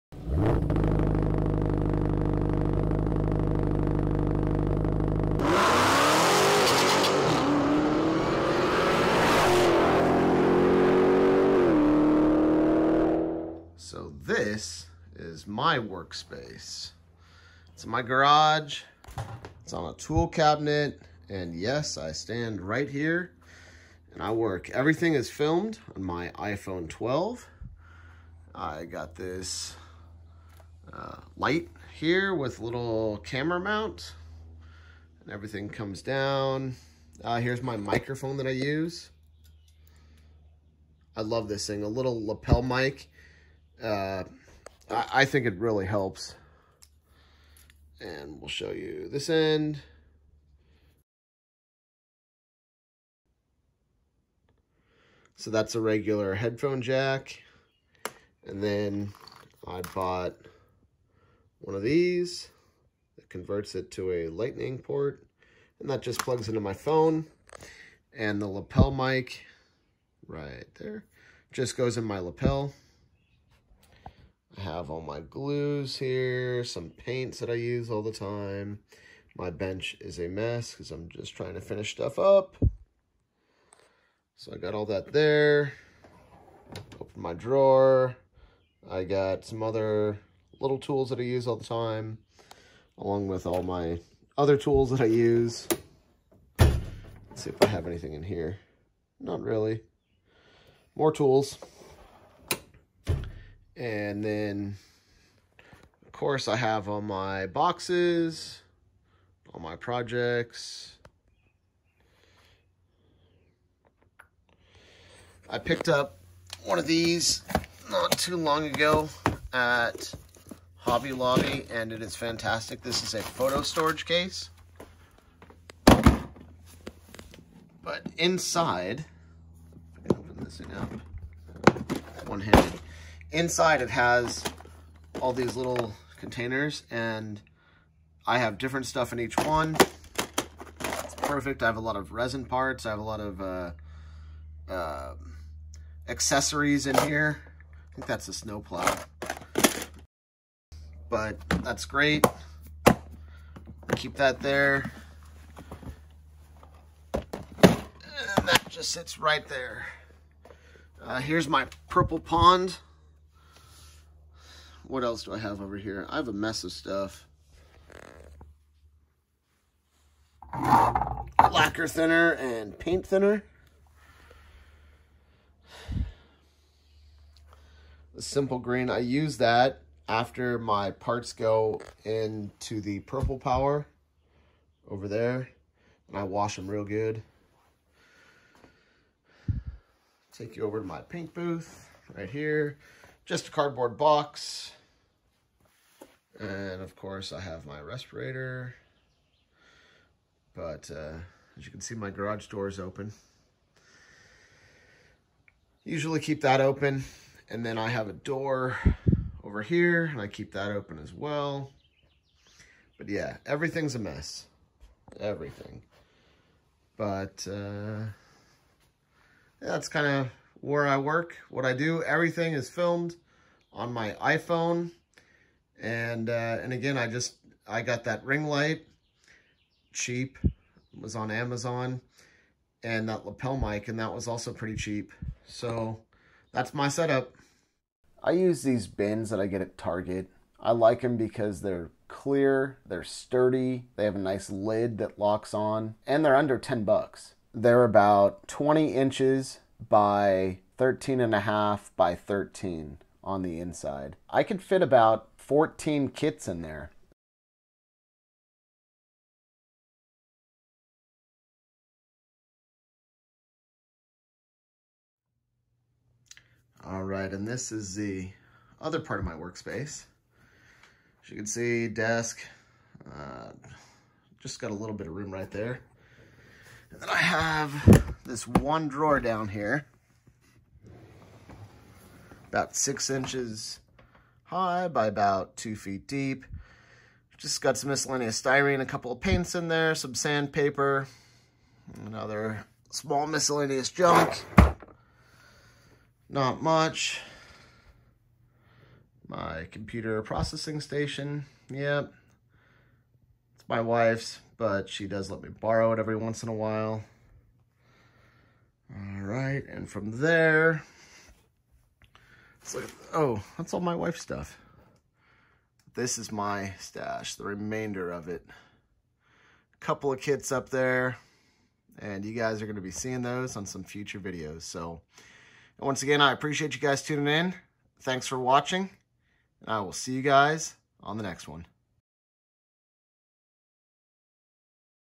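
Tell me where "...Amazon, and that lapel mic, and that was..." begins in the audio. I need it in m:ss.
3:51.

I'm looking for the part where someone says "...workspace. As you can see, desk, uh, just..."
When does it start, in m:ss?
4:29.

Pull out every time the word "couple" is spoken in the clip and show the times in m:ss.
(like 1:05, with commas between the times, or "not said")
4:48, 5:19.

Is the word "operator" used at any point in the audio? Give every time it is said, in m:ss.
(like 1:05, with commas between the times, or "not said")
not said.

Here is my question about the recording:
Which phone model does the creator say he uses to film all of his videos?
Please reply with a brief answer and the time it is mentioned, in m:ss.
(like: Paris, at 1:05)
iPhone 12, at 0:26.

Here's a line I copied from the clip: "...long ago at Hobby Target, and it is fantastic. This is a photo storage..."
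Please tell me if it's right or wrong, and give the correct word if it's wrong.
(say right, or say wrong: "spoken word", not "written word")
wrong: "Lobby", not "Target".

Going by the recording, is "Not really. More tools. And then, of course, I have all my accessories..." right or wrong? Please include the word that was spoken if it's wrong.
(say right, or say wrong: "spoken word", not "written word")
wrong: "boxes", not "accessories".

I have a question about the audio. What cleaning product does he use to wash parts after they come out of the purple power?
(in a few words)
Simple Green.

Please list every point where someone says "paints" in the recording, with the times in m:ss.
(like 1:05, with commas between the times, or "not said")
1:16, 2:52, 3:10, 4:49.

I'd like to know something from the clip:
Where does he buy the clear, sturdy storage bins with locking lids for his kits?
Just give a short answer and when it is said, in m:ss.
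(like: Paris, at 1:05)
Target, at 3:59.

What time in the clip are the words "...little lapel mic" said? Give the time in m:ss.
0:41.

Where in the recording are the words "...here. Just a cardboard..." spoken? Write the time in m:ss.
3:12.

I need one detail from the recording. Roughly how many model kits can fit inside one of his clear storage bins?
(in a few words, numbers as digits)
14.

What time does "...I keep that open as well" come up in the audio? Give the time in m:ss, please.
3:30.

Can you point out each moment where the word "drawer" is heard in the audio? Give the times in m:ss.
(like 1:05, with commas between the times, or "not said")
1:27, 4:38.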